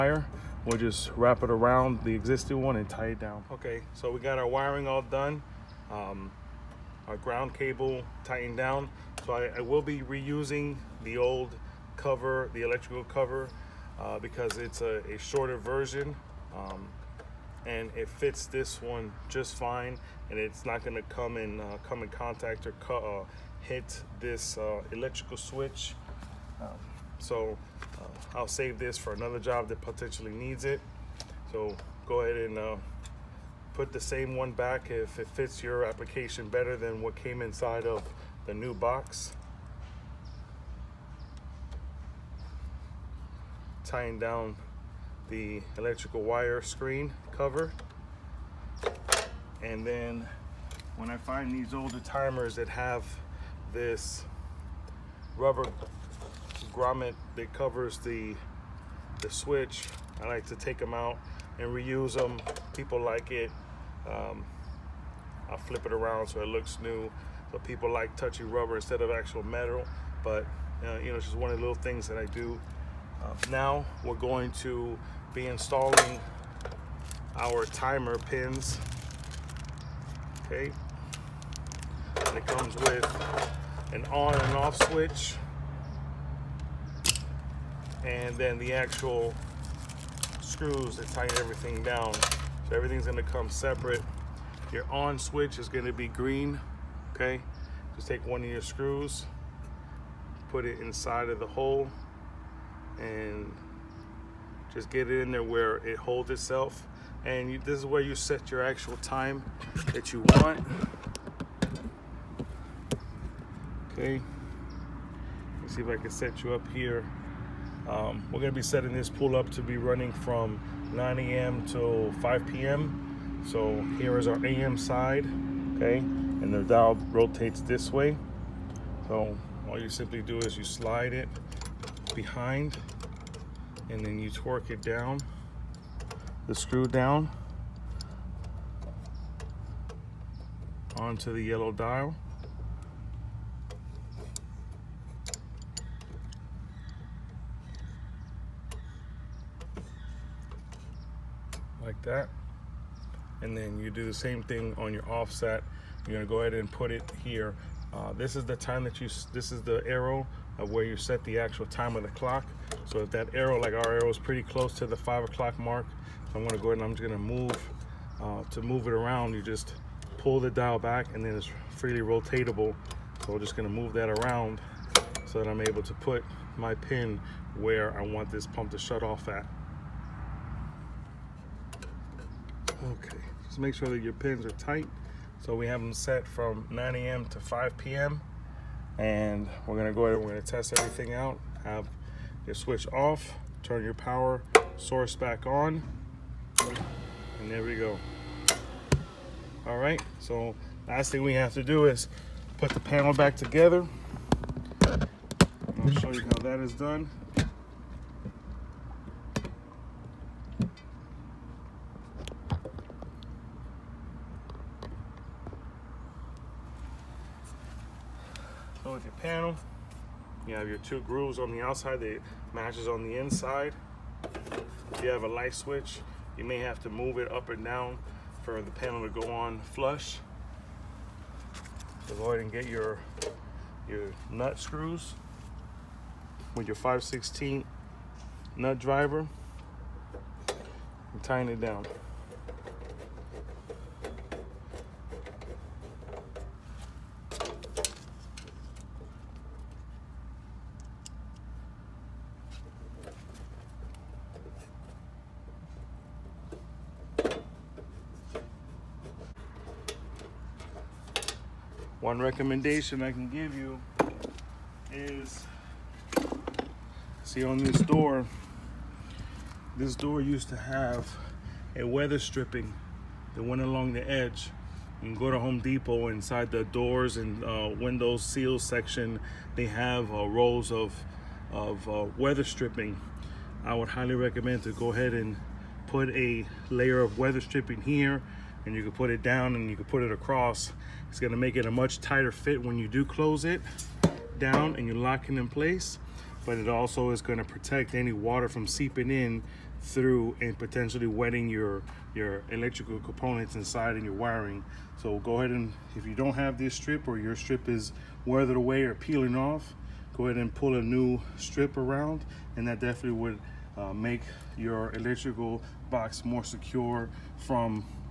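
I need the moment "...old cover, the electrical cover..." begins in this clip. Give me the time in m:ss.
0:11.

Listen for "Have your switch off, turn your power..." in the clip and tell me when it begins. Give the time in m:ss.
3:11.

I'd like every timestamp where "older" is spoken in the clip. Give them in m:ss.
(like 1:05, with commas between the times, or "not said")
0:51.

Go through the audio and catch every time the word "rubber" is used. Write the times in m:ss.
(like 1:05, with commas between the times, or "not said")
0:55, 1:08.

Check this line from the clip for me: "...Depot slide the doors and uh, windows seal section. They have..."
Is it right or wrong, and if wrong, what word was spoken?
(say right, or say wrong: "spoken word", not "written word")
wrong: "inside", not "slide".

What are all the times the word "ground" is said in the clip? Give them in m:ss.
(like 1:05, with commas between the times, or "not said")
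0:07.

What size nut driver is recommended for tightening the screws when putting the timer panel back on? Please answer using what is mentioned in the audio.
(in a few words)
5/16.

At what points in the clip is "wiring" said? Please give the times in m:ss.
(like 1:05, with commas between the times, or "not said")
0:04, 5:04.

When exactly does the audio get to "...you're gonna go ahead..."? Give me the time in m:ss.
2:36.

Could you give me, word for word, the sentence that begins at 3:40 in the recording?
your two grooves on the outside that matches on the inside.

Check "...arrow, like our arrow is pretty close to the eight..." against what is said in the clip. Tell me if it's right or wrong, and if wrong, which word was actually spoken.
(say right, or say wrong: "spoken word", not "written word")
wrong: "five", not "eight".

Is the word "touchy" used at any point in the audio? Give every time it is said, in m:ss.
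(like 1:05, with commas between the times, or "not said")
1:08.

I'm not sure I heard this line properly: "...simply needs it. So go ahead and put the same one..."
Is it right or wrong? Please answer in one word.
wrong.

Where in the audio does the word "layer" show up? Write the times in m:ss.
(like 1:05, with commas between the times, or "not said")
4:46.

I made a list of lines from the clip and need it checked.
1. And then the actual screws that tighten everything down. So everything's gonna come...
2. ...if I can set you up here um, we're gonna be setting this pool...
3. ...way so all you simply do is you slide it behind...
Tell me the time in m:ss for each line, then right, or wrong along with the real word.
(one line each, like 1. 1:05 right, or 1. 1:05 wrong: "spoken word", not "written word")
1. 1:28 right
2. 1:55 right
3. 2:07 right.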